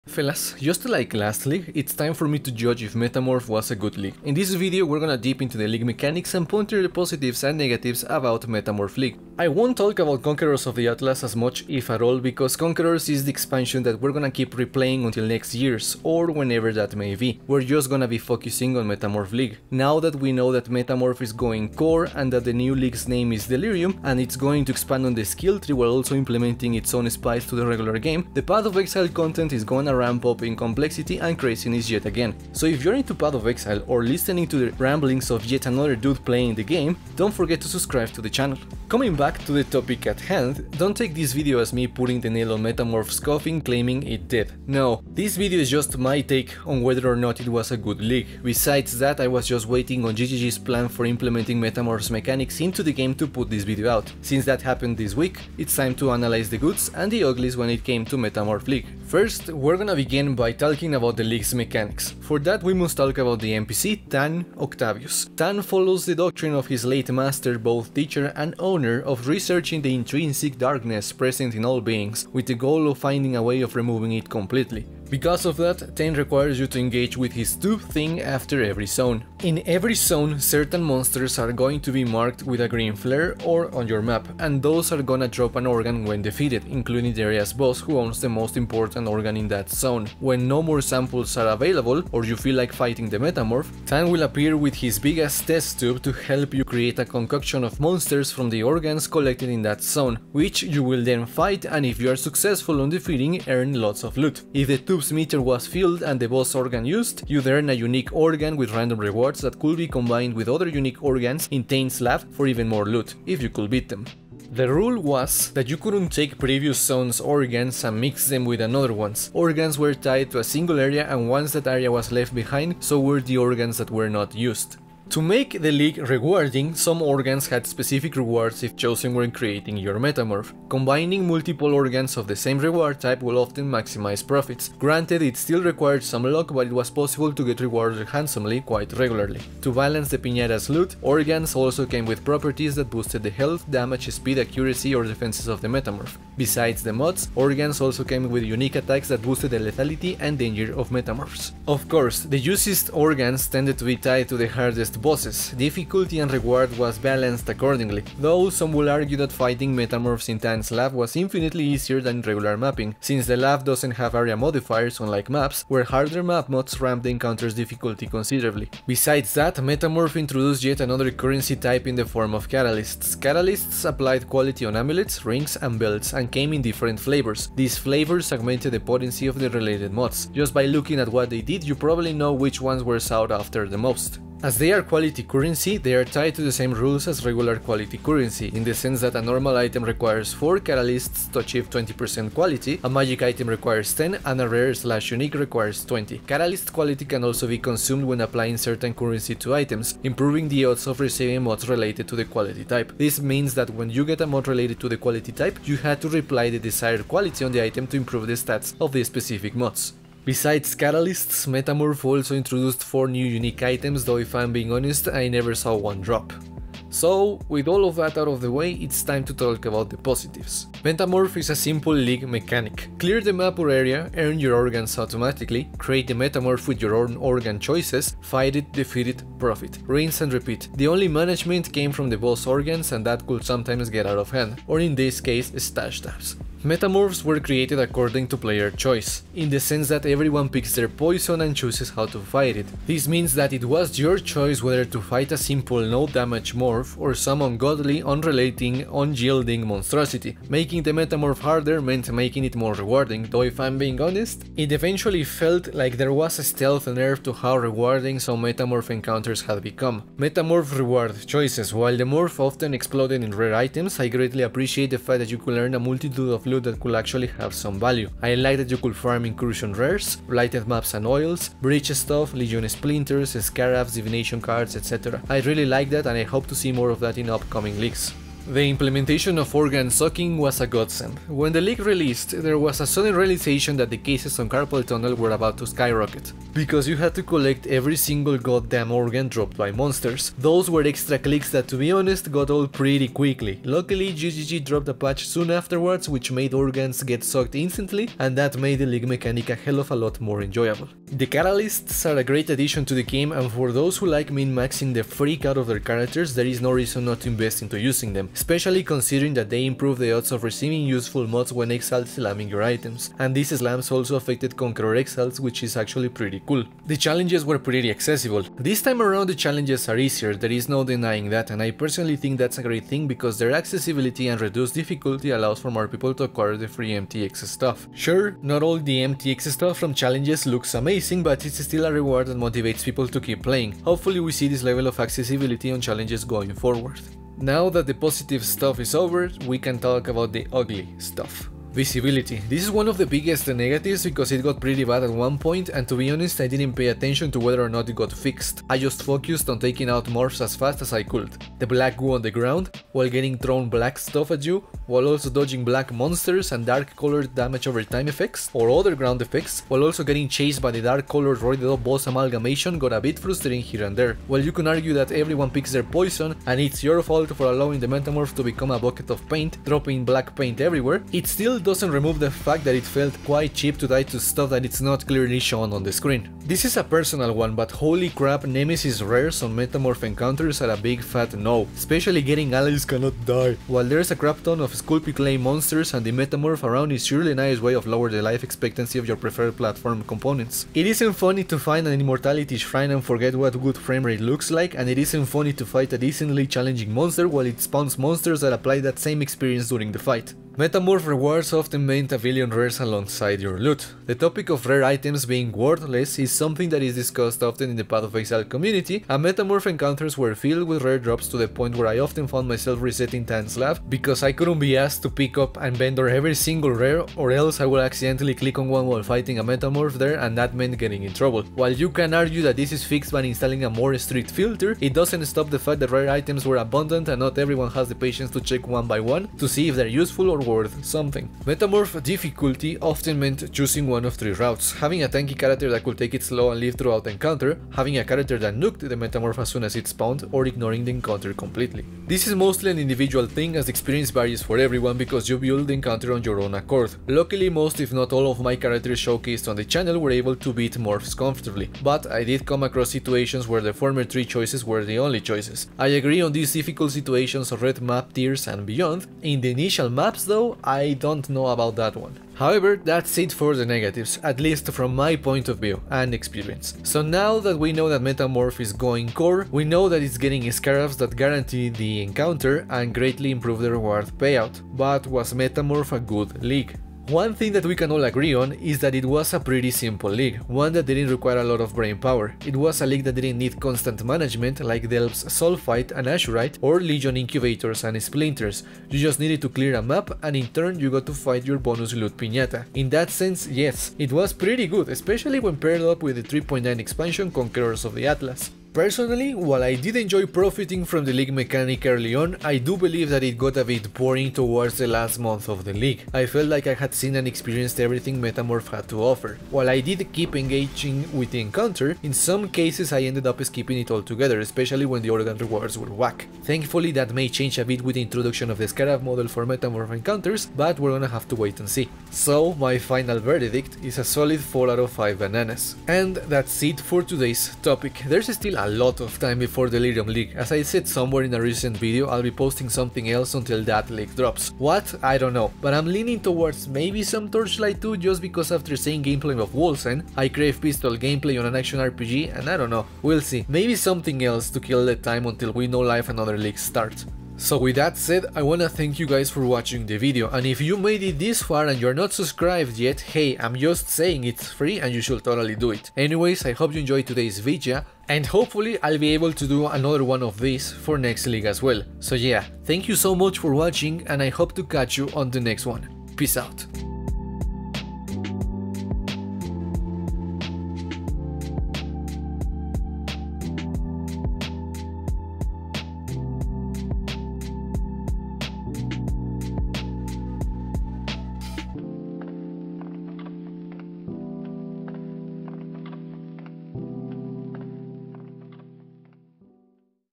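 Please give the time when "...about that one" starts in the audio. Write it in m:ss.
7:41.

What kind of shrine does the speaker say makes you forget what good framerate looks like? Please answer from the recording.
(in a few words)
Immortality Shrine.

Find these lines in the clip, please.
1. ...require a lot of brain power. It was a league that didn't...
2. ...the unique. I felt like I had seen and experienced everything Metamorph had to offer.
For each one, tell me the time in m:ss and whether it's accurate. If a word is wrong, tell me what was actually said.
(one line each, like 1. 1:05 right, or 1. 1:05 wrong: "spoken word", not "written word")
1. 8:01 right
2. 8:25 wrong: "league", not "unique".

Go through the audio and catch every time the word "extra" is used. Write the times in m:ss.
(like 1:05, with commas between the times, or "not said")
4:50.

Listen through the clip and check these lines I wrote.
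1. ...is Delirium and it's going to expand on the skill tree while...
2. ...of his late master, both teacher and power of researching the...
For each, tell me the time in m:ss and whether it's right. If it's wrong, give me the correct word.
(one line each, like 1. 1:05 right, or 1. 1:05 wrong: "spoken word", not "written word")
1. 0:23 right
2. 1:06 wrong: "owner", not "power".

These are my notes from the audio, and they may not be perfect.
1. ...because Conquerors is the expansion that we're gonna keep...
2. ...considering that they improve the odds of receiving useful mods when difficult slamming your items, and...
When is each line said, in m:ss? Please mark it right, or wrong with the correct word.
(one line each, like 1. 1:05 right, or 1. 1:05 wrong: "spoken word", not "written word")
1. 0:12 right
2. 5:08 wrong: "exalt", not "difficult".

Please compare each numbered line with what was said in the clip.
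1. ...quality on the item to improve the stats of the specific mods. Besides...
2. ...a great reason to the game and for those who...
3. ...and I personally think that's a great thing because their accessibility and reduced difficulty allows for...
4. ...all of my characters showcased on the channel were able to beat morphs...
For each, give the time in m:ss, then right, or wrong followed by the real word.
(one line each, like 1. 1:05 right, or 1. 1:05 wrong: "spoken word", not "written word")
1. 3:27 right
2. 5:02 wrong: "addition", not "reason"
3. 5:21 right
4. 7:28 right.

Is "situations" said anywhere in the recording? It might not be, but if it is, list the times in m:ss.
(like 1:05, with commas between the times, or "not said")
7:32, 7:36.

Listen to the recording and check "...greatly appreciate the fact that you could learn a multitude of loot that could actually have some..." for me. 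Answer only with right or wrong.
right.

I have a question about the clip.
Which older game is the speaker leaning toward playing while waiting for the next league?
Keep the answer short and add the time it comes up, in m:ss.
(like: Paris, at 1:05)
Torchlight 2, at 8:57.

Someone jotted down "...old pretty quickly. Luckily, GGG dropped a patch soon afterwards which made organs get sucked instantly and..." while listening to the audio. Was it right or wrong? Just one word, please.
right.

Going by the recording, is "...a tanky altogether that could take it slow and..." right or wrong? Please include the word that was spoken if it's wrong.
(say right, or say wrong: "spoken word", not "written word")
wrong: "character", not "altogether".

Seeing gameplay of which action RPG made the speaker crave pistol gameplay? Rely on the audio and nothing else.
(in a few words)
Wolcen.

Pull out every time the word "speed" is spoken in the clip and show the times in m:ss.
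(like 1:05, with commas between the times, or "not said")
2:24.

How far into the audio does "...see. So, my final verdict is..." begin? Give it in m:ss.
8:41.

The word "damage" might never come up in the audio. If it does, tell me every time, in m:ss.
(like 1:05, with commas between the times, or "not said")
2:23, 4:06, 5:57.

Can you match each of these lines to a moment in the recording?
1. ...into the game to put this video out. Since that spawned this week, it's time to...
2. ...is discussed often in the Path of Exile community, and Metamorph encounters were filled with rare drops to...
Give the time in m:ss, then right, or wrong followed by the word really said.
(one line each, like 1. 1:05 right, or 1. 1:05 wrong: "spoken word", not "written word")
1. 0:52 wrong: "happened", not "spawned"
2. 6:46 right.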